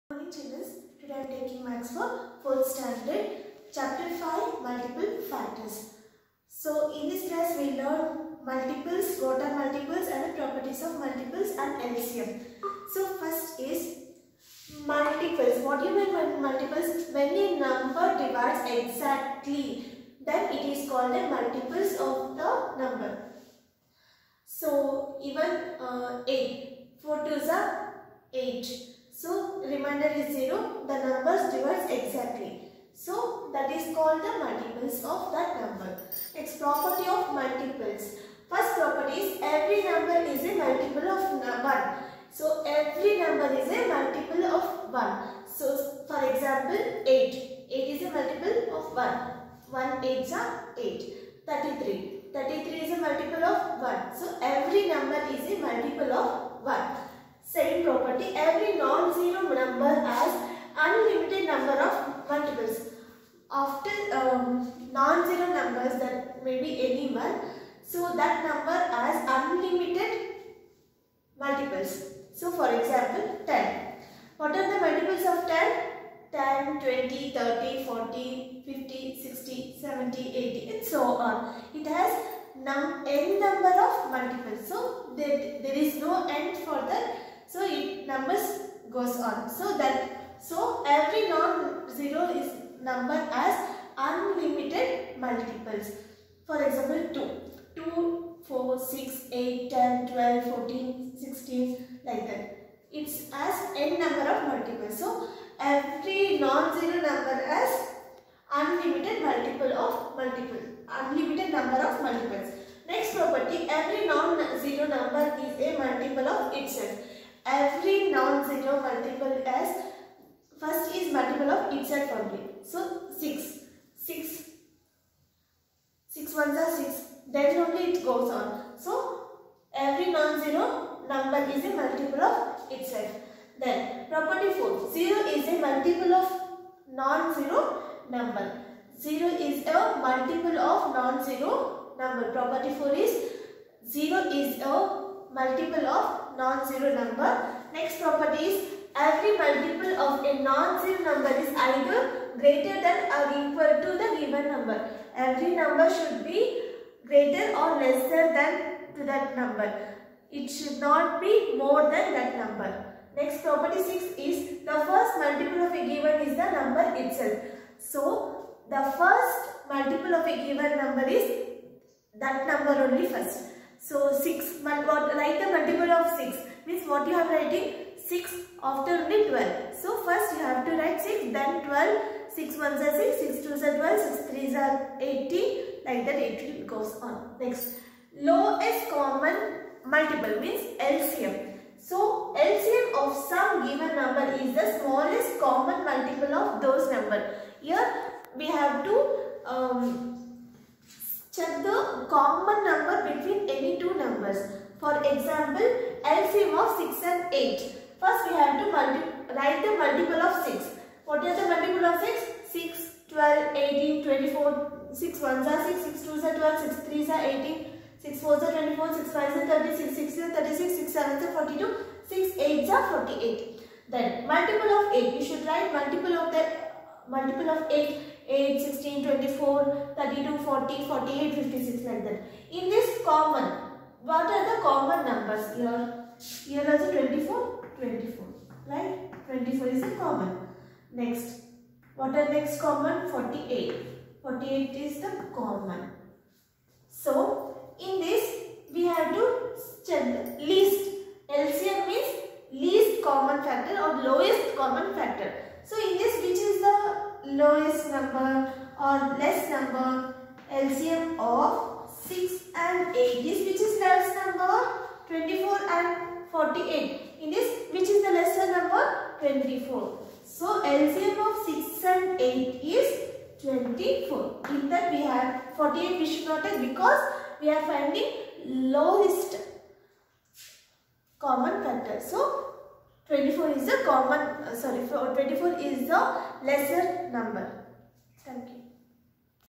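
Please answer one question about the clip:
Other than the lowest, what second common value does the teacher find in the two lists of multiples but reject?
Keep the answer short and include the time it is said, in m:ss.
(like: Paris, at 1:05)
48, at 4:04.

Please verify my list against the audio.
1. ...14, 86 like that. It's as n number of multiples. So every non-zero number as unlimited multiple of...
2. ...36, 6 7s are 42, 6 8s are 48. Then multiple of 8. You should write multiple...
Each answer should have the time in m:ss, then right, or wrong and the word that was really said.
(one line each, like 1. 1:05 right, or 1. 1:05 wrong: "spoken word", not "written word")
1. 1:40 wrong: "16", not "86"
2. 3:40 right.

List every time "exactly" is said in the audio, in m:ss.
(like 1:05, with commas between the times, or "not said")
0:18, 0:31.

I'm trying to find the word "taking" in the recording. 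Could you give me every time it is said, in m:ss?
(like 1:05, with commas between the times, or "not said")
0:01.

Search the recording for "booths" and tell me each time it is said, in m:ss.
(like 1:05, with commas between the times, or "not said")
not said.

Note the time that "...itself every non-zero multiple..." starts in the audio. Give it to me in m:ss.
1:56.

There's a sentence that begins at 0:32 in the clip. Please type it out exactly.
So that is called the multiples of that number.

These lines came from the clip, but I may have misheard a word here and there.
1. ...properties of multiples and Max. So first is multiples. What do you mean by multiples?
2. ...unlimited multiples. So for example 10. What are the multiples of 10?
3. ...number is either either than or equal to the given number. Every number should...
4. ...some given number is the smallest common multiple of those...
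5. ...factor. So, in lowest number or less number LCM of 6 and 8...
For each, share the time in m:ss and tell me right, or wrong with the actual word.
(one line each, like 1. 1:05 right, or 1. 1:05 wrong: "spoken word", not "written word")
1. 0:10 wrong: "LCM", not "Max"
2. 1:09 right
3. 2:31 wrong: "greater", not "either"
4. 3:13 right
5. 4:14 right.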